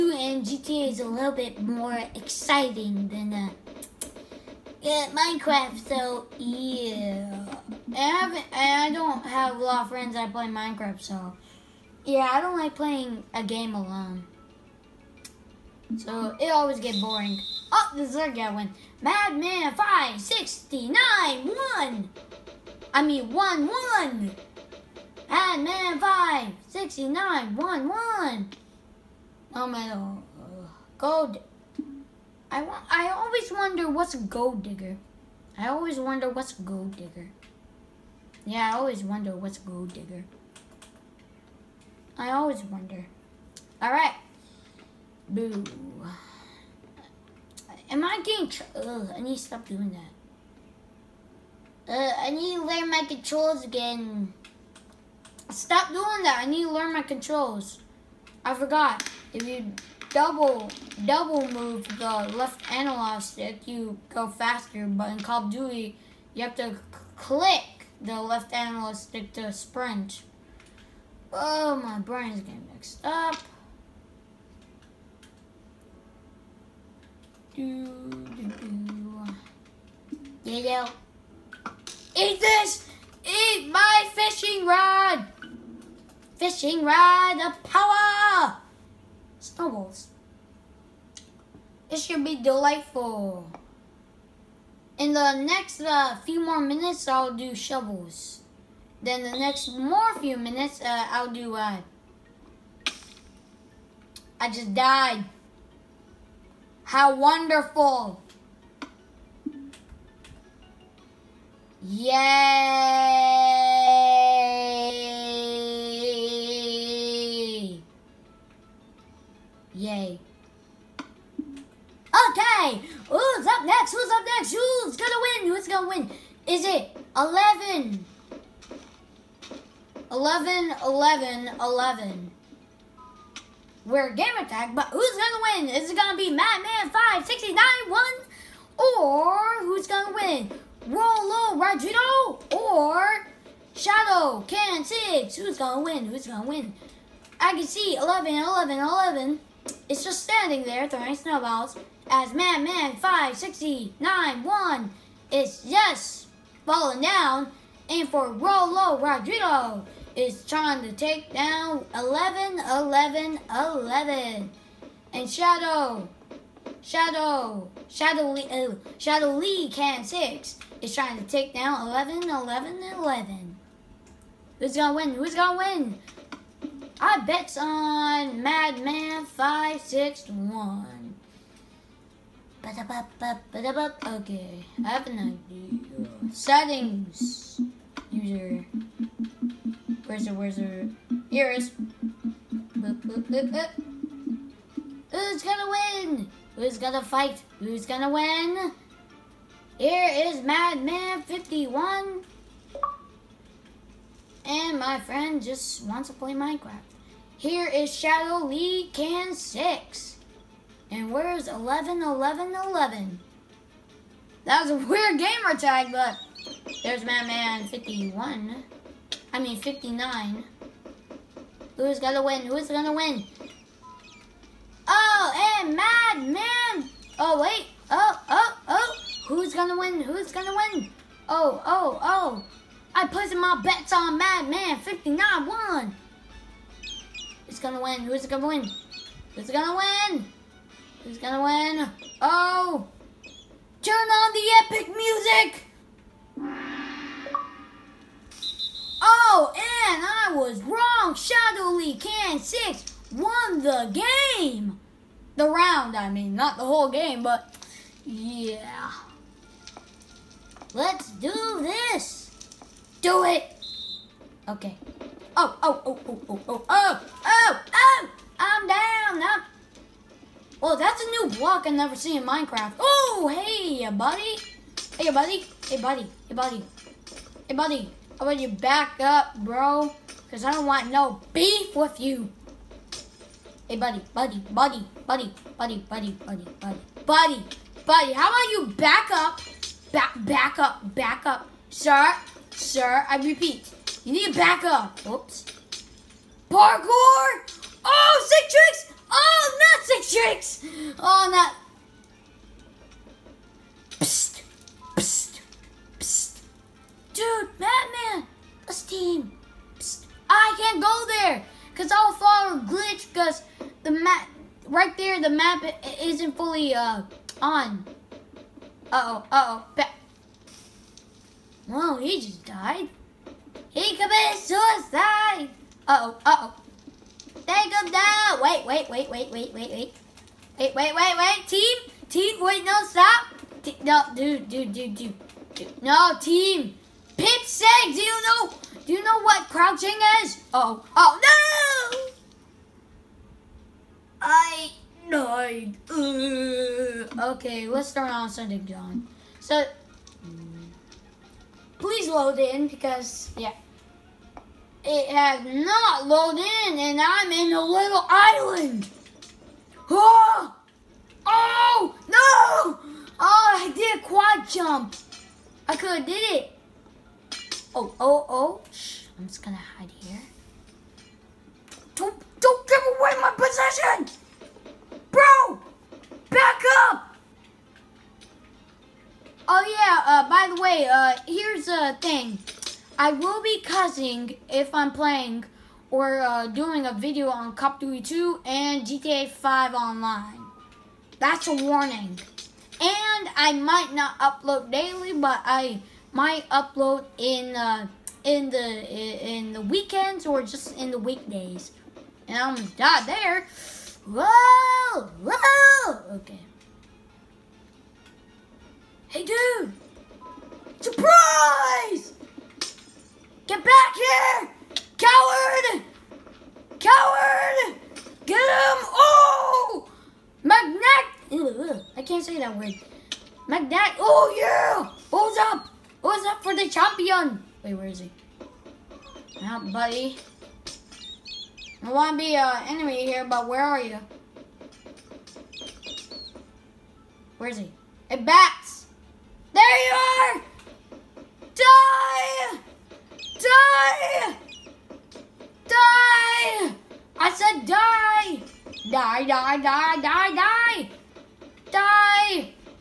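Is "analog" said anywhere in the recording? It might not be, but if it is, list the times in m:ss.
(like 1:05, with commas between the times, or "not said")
1:02, 1:08.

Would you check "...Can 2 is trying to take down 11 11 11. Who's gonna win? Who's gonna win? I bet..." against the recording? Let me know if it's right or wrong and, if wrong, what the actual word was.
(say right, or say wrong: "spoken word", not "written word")
wrong: "6", not "2".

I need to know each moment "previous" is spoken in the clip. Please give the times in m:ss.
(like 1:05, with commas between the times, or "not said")
not said.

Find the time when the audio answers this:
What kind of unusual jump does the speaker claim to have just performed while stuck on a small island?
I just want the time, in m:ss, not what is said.
6:04.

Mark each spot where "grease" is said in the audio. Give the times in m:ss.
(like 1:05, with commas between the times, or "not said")
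not said.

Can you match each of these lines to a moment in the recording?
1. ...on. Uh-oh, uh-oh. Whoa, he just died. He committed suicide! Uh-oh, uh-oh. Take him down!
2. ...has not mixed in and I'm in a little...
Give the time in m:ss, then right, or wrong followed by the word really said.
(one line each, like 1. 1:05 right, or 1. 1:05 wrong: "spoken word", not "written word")
1. 5:17 right
2. 5:55 wrong: "loaded", not "mixed".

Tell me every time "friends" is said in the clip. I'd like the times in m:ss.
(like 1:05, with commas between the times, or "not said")
0:09, 3:25.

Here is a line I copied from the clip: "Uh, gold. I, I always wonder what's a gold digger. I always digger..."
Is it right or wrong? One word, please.
wrong.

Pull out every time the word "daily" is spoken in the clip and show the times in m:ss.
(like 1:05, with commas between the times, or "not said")
6:34.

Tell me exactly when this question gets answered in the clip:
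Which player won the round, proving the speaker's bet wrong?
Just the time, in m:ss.
4:11.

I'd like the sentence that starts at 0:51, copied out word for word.
Uh, I need to learn my controls again.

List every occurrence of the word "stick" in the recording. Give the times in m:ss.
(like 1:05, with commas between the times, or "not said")
1:03, 1:08.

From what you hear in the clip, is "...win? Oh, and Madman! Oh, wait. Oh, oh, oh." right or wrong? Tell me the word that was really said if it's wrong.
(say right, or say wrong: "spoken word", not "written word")
right.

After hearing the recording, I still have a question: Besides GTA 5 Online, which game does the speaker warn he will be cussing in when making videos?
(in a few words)
Cop Duty 2.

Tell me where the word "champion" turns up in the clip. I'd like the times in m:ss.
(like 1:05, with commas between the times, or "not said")
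7:06.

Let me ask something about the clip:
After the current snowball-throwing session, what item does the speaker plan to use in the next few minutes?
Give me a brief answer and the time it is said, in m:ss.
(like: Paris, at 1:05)
shovels, at 1:37.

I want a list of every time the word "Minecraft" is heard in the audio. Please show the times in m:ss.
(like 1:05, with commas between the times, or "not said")
0:05, 0:10, 3:26, 4:32.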